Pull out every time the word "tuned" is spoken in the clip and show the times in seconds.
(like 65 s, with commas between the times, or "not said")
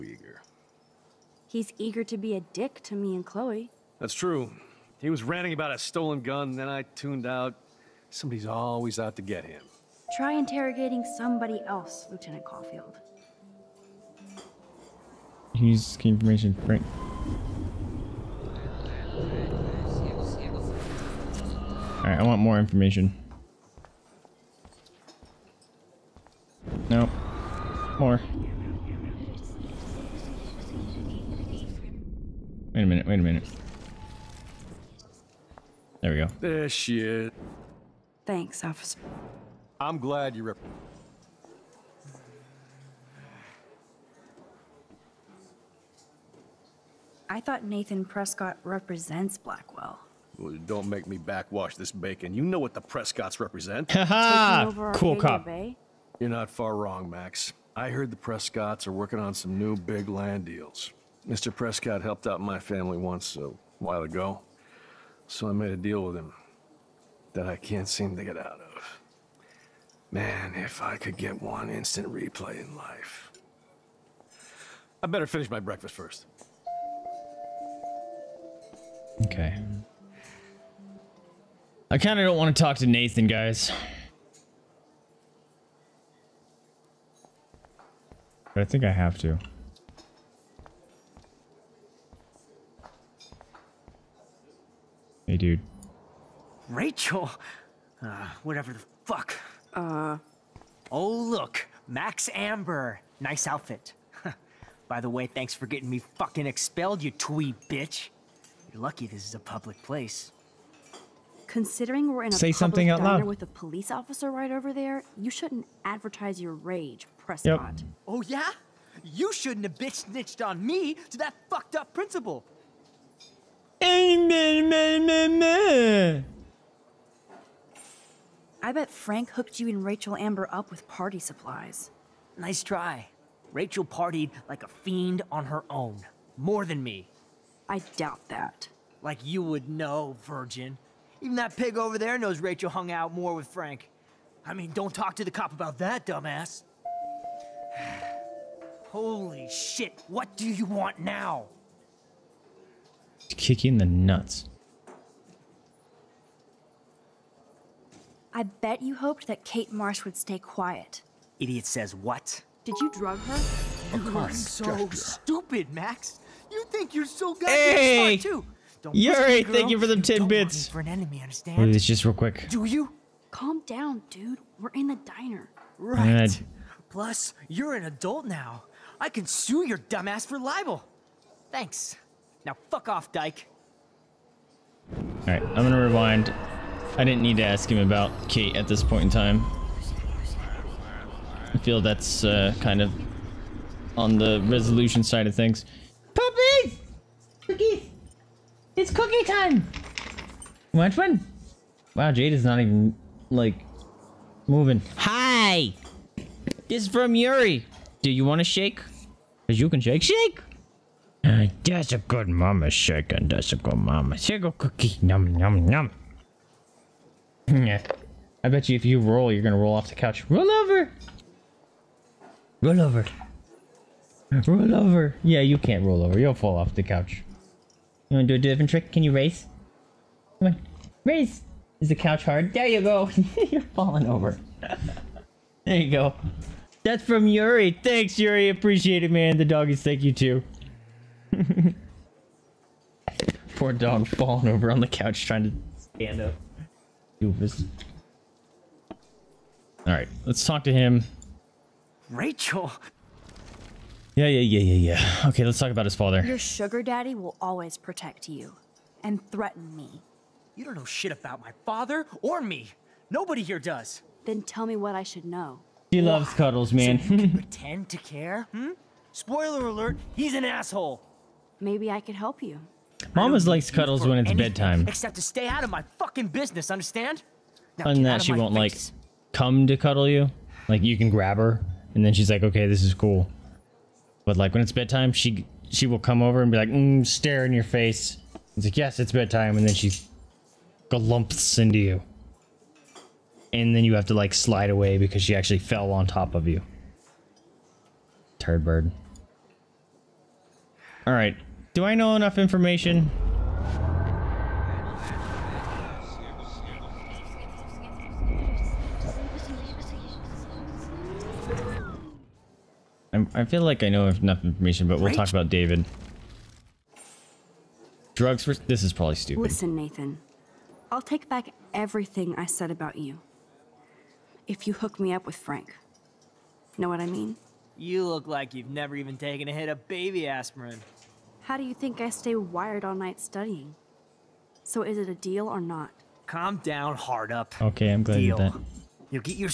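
6 s.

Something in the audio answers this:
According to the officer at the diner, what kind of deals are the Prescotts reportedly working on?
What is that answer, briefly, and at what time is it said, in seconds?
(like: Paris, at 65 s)
Land deals, at 59 s.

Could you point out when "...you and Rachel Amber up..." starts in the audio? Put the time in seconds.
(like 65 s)
129 s.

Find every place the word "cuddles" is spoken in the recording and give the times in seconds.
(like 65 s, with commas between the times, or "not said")
266 s, 273 s, 279 s.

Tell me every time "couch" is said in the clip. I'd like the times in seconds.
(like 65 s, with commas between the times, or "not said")
219 s, 226 s, 231 s, 244 s.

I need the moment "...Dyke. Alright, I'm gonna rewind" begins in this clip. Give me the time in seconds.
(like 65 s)
183 s.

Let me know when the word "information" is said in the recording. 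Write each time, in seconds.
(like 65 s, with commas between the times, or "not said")
16 s, 22 s, 302 s, 314 s.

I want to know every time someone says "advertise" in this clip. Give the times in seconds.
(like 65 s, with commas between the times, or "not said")
115 s.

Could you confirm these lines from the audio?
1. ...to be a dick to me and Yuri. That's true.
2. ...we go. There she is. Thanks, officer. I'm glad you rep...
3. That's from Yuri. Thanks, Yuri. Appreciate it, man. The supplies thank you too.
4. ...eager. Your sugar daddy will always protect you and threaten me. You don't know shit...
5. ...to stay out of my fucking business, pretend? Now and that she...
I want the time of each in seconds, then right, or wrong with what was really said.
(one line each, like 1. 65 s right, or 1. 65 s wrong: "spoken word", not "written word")
1. 2 s wrong: "Chloe", not "Yuri"
2. 36 s right
3. 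236 s wrong: "doggies", not "supplies"
4. 255 s wrong: "father", not "eager"
5. 275 s wrong: "understand", not "pretend".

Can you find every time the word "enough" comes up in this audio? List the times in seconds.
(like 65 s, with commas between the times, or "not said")
302 s, 314 s.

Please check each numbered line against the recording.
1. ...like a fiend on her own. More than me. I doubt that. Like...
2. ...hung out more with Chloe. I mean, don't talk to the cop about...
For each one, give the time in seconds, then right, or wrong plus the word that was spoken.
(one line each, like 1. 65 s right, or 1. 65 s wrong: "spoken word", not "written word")
1. 134 s right
2. 142 s wrong: "Frank", not "Chloe".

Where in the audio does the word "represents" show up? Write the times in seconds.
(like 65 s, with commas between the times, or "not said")
48 s, 53 s.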